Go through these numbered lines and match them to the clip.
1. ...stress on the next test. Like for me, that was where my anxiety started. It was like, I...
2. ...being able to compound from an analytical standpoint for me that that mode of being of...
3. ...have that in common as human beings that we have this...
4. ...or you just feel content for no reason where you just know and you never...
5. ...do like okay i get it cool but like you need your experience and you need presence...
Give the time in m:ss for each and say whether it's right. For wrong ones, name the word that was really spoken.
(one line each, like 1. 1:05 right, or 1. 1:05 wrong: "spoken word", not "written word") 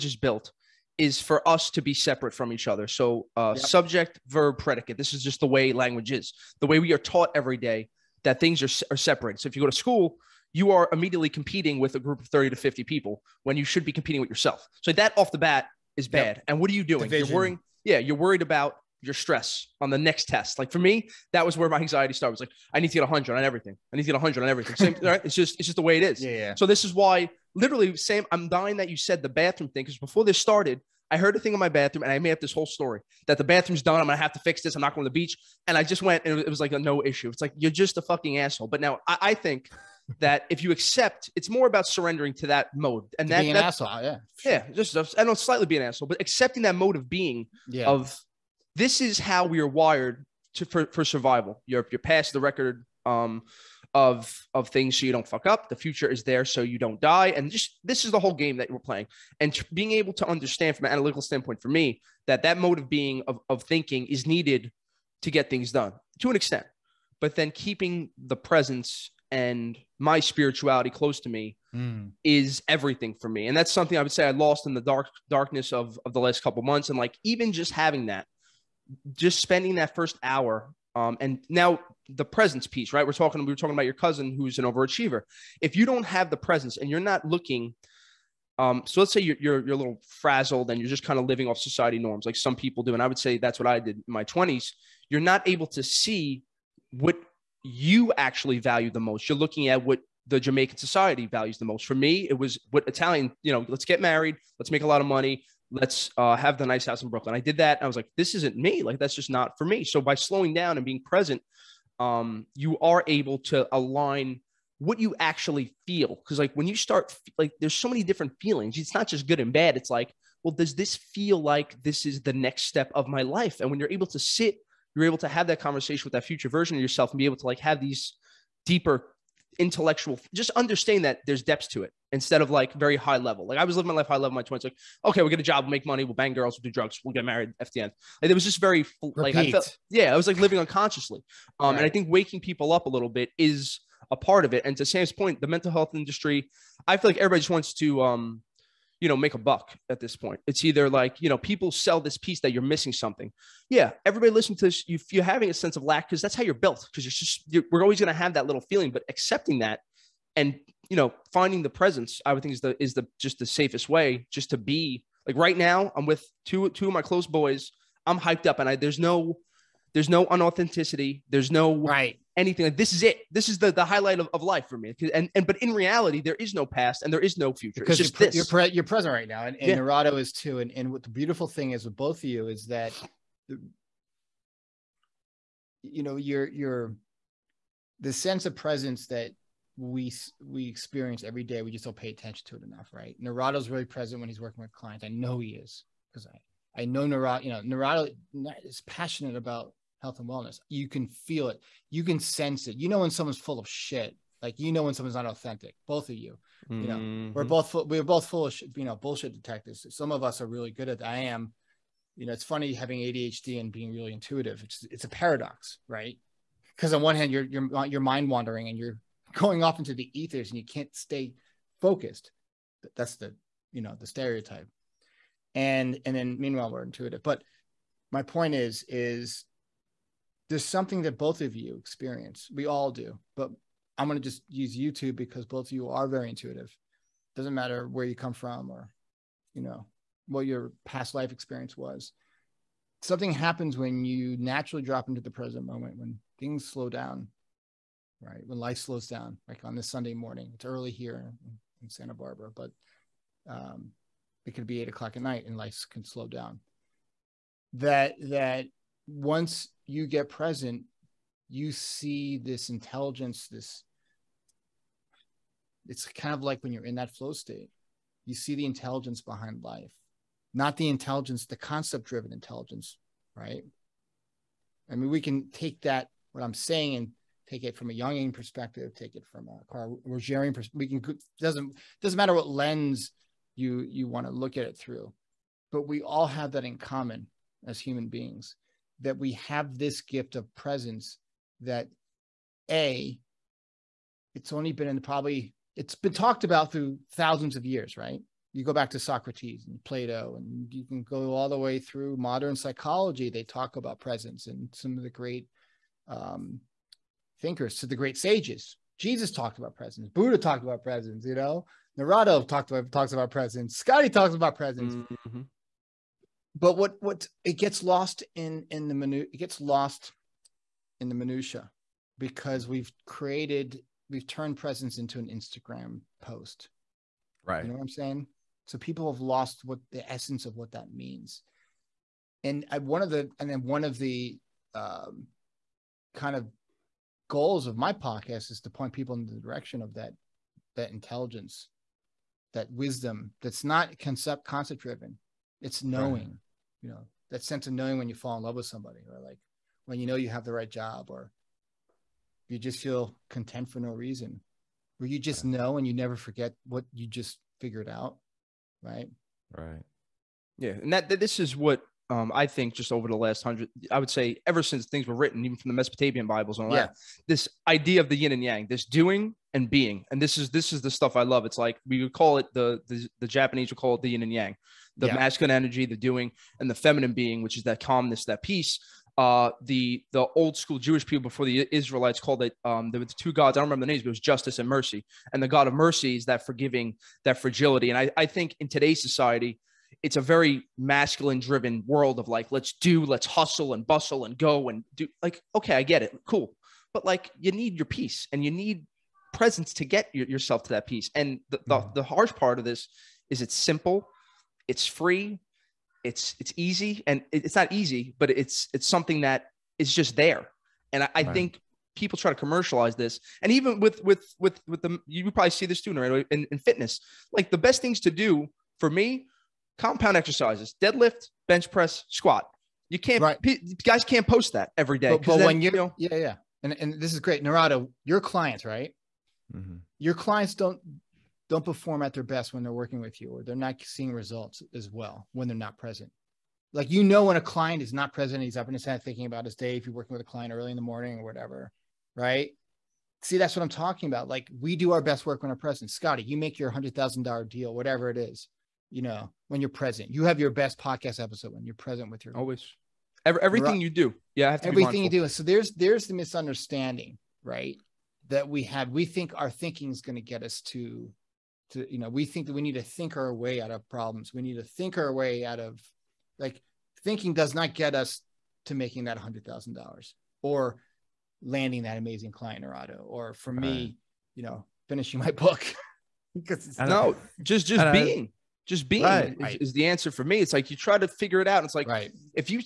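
1. 0:19 right
2. 0:59 wrong: "understand", not "compound"
3. 4:46 right
4. 5:51 right
5. 6:34 wrong: "peace", not "experience".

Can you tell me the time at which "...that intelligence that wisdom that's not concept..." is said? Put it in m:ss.
5:40.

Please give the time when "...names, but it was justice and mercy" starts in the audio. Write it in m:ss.
6:23.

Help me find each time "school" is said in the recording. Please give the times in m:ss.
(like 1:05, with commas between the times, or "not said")
0:09, 6:20.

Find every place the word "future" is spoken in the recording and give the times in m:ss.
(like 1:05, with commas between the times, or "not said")
0:55, 2:06, 2:57.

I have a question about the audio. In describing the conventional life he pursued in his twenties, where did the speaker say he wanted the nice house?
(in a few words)
Brooklyn.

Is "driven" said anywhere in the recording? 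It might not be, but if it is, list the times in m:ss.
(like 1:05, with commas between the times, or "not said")
4:32, 5:44, 6:31.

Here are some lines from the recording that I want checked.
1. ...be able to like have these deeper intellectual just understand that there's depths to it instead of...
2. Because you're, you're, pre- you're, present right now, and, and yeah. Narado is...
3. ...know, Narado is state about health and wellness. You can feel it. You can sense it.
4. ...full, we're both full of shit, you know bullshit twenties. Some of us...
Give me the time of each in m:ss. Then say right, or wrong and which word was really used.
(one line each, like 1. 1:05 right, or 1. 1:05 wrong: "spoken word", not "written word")
1. 2:07 right
2. 2:57 right
3. 3:17 wrong: "passionate", not "state"
4. 3:27 wrong: "detectives", not "twenties".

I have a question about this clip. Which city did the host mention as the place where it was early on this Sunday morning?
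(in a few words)
Santa Barbara.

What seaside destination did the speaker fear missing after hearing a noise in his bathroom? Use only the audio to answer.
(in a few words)
the beach.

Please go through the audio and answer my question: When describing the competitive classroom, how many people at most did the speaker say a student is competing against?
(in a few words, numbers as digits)
50.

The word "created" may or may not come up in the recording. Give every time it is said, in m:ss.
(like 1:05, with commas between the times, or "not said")
5:23.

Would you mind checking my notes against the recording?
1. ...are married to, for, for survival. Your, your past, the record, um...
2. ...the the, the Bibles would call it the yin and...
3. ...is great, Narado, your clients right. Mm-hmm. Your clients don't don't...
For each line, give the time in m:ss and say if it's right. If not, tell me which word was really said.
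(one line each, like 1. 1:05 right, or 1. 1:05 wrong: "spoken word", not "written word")
1. 0:49 wrong: "wired", not "married"
2. 6:12 wrong: "Japanese", not "Bibles"
3. 7:07 right.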